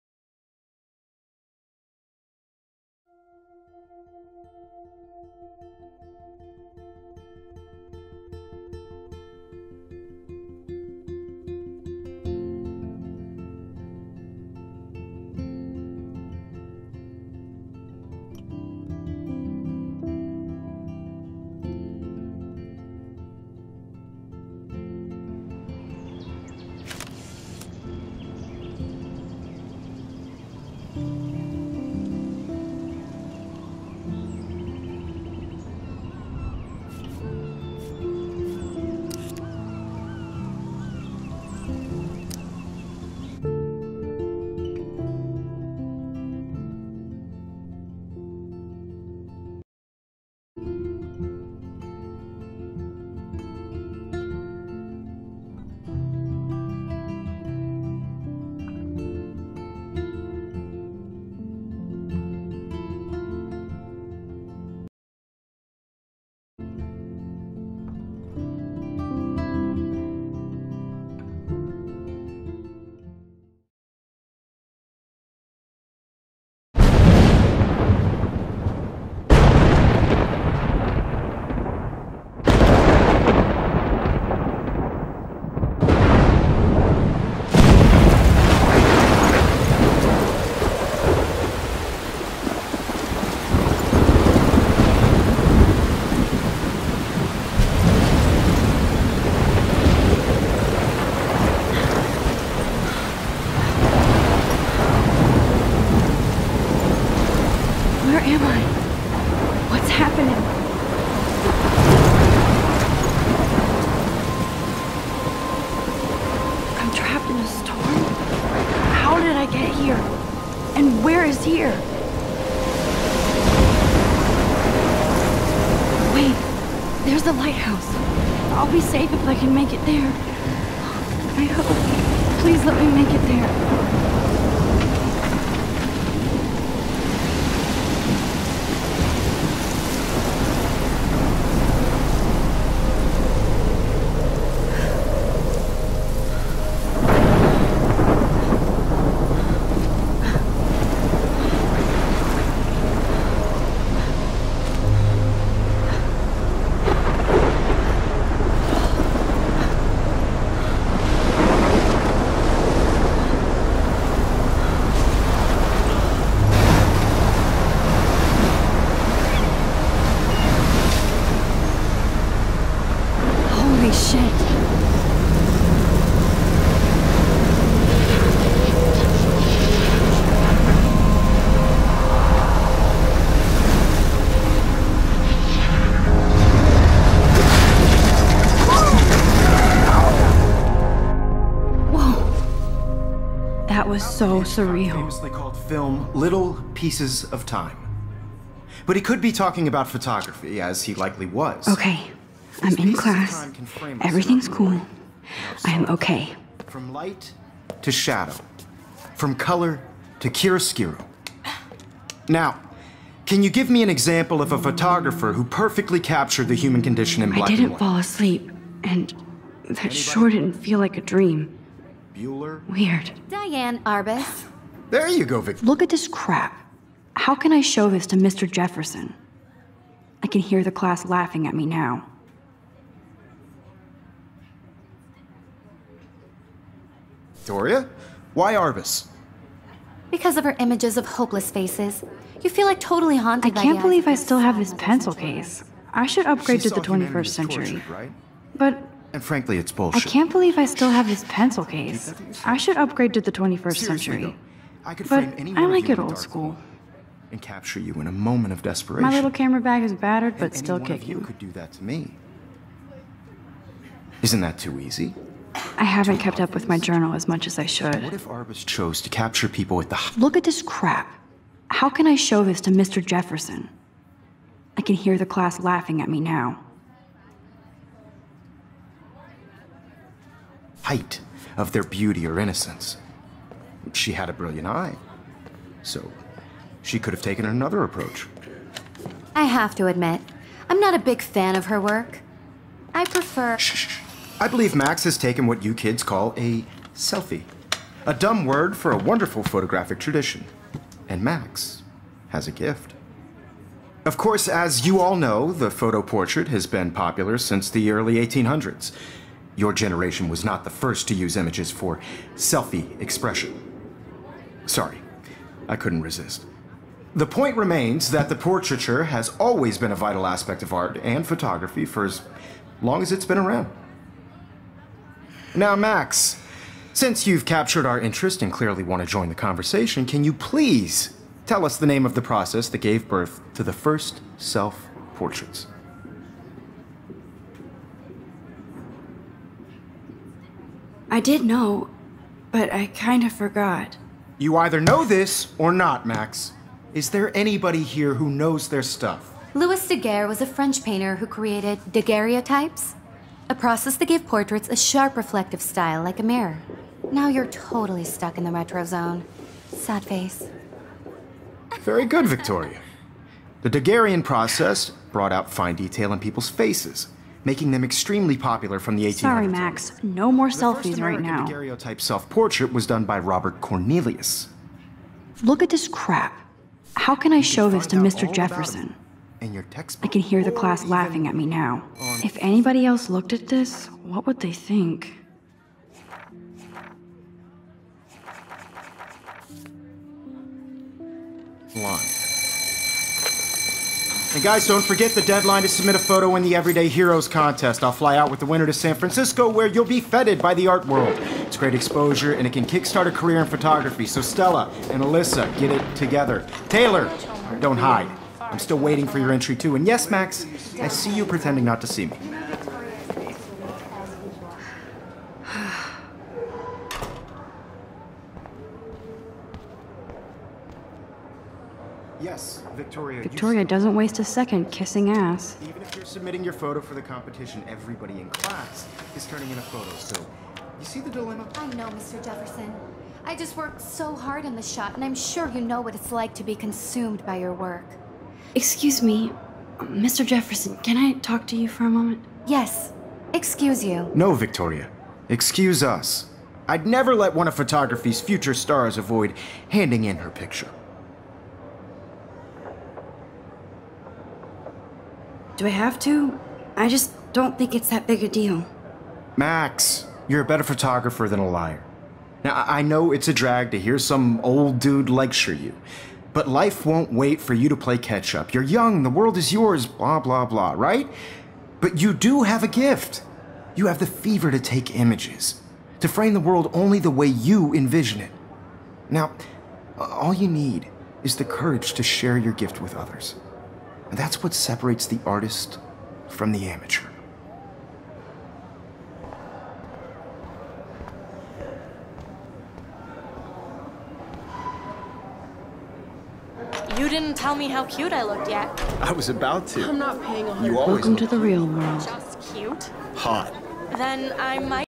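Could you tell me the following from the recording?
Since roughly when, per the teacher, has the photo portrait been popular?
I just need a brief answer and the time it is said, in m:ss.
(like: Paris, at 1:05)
early 1800s, at 5:07.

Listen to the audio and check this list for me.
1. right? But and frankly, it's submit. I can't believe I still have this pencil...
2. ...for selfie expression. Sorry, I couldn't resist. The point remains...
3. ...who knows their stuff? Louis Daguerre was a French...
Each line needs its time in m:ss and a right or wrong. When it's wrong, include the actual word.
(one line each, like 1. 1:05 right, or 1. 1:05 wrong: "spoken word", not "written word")
1. 4:07 wrong: "bullshit", not "submit"
2. 5:11 right
3. 5:48 right.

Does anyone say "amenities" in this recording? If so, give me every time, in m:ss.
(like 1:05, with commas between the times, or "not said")
not said.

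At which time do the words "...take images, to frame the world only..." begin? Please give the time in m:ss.
7:54.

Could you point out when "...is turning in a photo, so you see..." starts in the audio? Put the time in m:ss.
7:09.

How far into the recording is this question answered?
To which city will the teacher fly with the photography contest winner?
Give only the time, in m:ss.
6:38.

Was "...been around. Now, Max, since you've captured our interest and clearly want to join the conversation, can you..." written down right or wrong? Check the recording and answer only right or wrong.
right.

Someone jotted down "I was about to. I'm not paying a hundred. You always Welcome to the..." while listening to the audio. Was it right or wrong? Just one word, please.
right.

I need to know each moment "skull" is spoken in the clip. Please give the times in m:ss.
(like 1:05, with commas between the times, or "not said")
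not said.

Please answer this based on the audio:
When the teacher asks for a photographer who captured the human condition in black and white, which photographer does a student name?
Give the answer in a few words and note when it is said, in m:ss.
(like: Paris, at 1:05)
Diane Arbus, at 3:43.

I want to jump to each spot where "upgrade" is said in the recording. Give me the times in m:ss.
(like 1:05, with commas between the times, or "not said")
4:06, 4:12.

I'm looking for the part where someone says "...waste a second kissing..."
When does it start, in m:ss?
7:03.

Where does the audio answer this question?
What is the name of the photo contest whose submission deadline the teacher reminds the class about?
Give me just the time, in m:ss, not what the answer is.
6:36.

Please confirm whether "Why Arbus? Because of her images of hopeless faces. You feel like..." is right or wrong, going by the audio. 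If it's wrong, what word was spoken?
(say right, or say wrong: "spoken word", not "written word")
right.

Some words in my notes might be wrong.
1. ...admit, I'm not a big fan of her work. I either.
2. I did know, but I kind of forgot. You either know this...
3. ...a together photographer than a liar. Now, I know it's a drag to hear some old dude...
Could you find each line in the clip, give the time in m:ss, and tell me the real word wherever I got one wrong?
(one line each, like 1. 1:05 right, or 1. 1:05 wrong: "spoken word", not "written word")
1. 4:49 wrong: "prefer", not "either"
2. 5:41 right
3. 7:40 wrong: "better", not "together".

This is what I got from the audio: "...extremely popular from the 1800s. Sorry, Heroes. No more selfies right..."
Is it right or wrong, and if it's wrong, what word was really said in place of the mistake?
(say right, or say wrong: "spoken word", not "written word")
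wrong: "Max", not "Heroes".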